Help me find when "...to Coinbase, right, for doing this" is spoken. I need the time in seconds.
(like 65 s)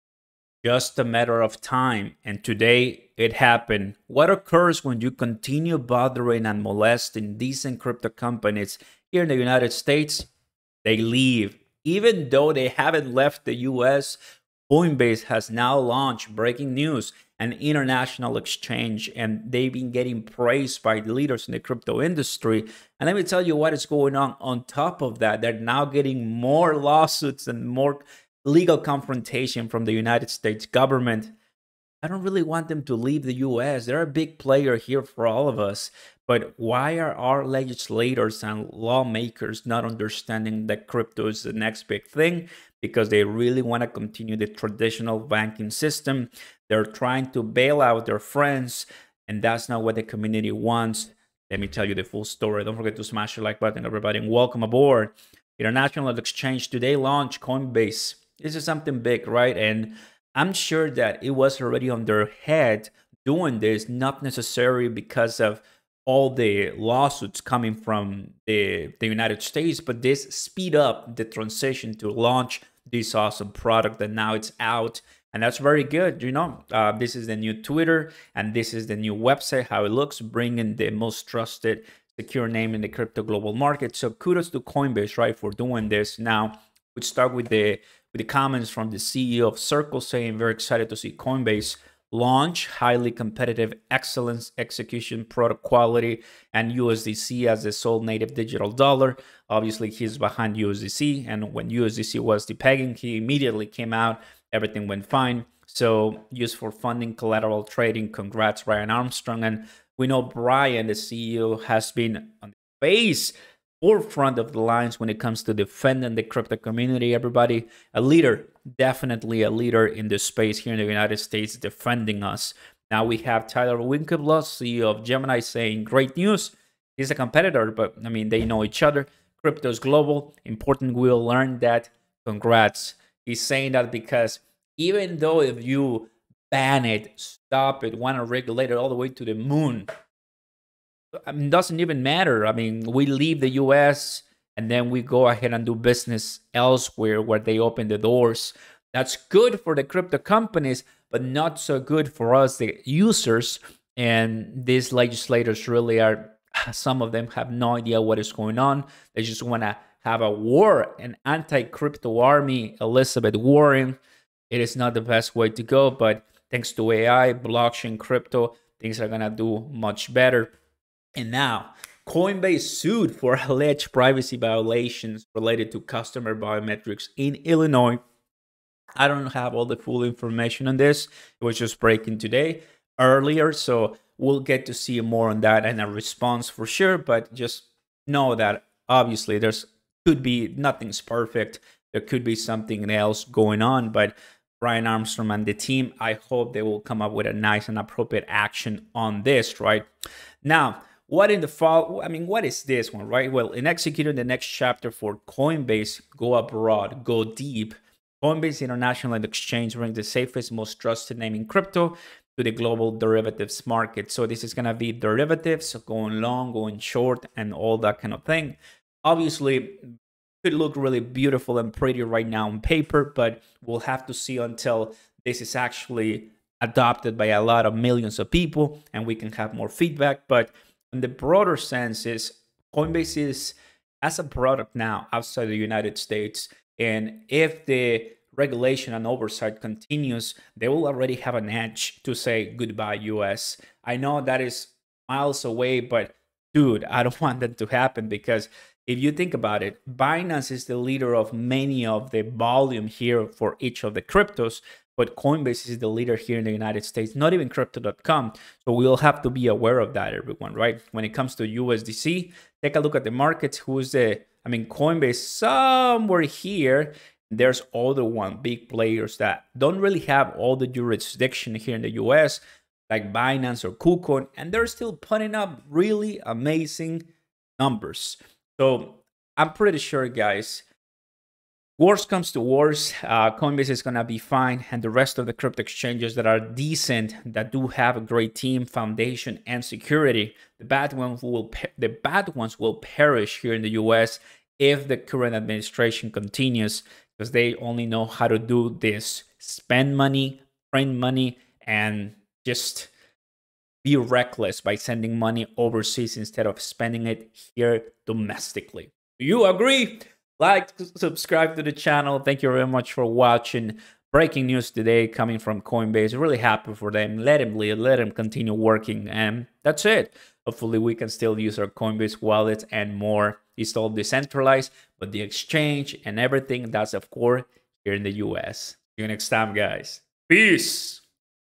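84 s.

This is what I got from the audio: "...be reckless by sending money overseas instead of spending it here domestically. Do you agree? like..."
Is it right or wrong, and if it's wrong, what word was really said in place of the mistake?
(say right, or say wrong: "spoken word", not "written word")
right.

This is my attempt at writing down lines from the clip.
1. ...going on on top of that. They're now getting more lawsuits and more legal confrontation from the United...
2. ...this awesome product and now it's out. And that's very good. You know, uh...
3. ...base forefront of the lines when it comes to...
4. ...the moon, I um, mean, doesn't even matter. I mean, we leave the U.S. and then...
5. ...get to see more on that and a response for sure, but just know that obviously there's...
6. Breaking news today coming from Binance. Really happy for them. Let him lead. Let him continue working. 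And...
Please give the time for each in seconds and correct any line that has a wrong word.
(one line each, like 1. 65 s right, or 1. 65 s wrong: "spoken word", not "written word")
1. 23 s right
2. 72 s right
3. 112 s right
4. 139 s right
5. 184 s right
6. 314 s wrong: "Coinbase", not "Binance".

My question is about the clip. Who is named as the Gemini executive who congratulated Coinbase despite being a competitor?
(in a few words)
Tyler Winklevoss.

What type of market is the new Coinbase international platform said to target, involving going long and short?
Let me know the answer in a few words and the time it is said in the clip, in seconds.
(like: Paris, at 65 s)
derivatives market, at 212 s.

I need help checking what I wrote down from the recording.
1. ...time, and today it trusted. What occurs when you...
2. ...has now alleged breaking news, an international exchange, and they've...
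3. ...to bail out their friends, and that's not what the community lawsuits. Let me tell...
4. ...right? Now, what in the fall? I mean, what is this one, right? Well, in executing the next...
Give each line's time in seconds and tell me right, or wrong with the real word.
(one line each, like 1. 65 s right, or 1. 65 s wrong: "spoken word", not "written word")
1. 1 s wrong: "happened", not "trusted"
2. 15 s wrong: "launched", not "alleged"
3. 47 s wrong: "wants", not "lawsuits"
4. 199 s right.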